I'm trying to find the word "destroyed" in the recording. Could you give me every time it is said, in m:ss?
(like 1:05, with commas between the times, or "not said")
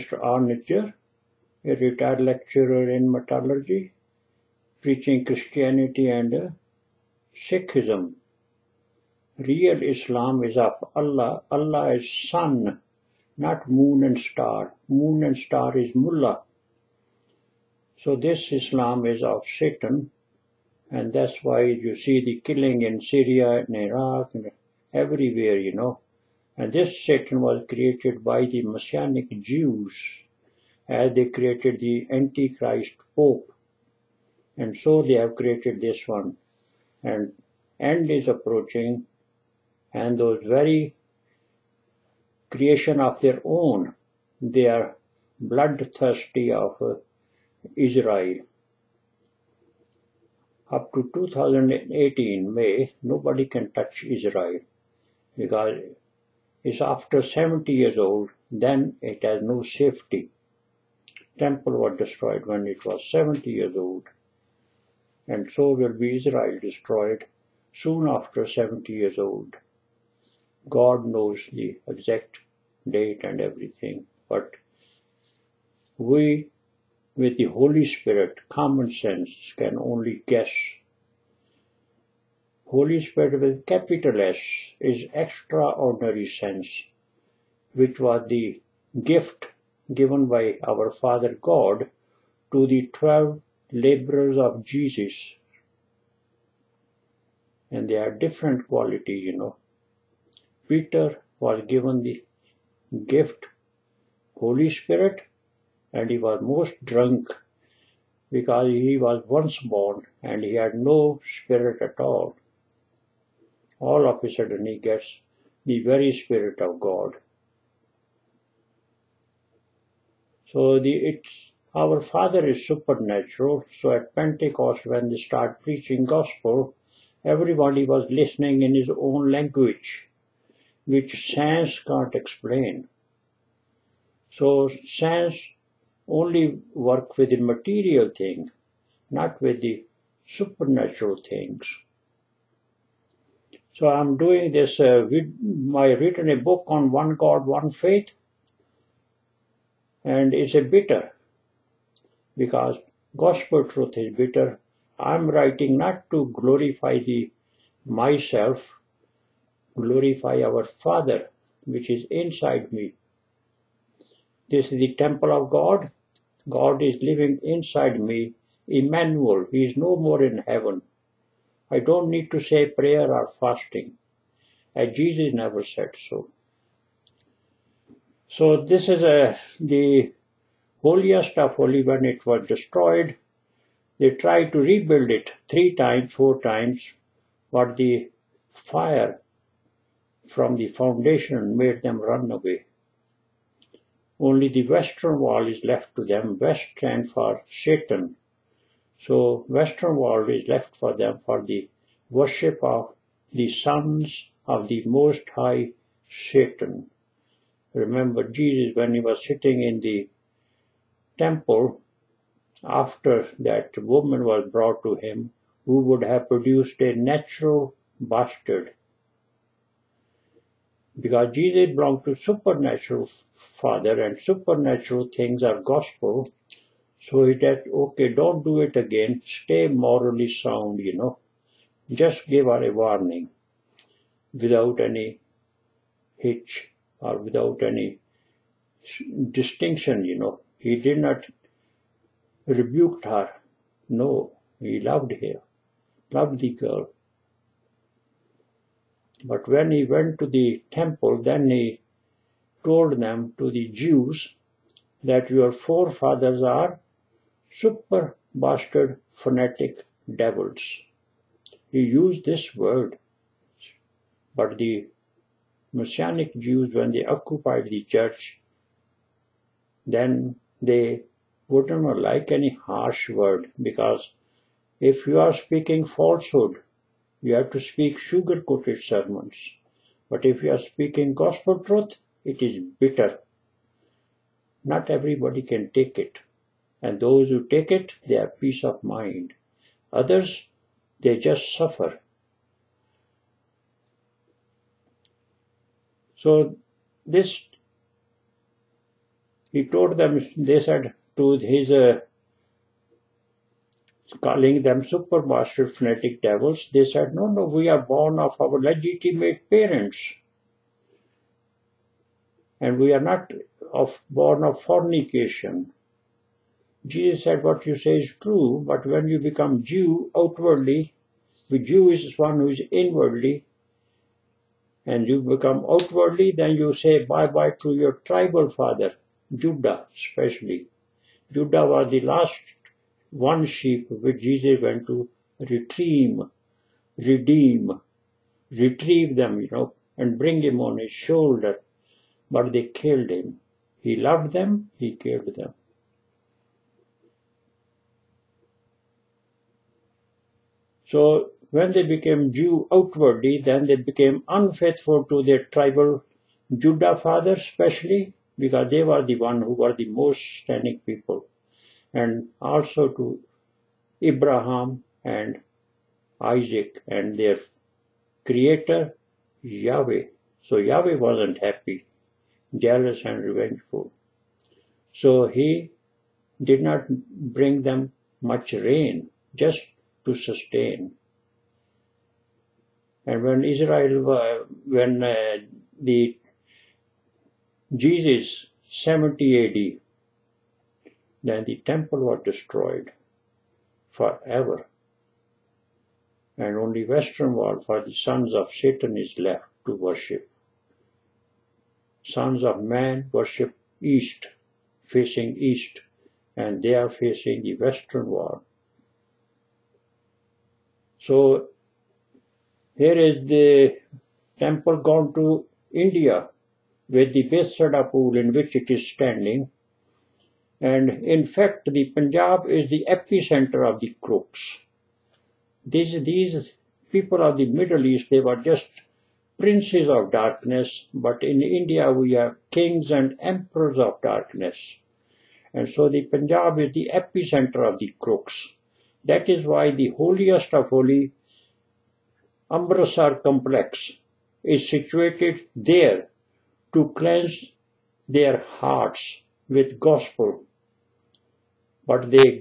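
1:01, 1:06, 3:02, 6:32.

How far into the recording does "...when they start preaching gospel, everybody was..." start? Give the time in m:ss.
2:04.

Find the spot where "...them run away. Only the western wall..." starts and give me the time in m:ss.
3:11.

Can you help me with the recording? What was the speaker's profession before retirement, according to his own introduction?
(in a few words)
Lecturer in metallurgy.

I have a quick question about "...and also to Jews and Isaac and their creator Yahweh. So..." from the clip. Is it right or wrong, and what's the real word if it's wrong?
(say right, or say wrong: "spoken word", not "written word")
wrong: "Abraham", not "Jews".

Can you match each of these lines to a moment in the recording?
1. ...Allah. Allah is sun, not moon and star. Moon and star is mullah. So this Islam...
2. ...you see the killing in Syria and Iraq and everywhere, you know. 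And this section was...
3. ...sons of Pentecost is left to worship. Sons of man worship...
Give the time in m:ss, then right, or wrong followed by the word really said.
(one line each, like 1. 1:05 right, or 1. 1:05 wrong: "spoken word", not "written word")
1. 0:10 right
2. 0:21 right
3. 6:37 wrong: "Satan", not "Pentecost".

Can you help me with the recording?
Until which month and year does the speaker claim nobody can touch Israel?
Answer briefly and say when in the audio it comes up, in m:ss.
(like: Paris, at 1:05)
May 2018, at 0:51.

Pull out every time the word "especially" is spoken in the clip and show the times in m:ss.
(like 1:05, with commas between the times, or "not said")
5:29, 5:57.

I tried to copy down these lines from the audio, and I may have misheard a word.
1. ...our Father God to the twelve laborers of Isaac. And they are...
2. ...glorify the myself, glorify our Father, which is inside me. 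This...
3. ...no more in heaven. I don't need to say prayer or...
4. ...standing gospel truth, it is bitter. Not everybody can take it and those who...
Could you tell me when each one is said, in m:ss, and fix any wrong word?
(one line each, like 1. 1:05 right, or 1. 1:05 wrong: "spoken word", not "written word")
1. 1:30 wrong: "Jesus", not "Isaac"
2. 2:36 right
3. 2:49 right
4. 4:40 wrong: "speaking", not "standing".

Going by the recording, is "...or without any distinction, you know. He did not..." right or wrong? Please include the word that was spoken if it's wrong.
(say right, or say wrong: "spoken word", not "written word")
right.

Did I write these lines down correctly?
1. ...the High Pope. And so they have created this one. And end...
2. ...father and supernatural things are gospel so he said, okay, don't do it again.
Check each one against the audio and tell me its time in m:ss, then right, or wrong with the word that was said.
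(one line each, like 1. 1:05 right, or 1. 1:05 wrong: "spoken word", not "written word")
1. 0:31 wrong: "Antichrist", not "High"
2. 3:43 right.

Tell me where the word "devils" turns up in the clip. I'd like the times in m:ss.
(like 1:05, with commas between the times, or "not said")
4:20, 5:06.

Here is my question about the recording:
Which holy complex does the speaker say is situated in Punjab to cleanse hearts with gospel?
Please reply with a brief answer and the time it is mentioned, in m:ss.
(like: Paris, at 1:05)
Amritsar, at 7:22.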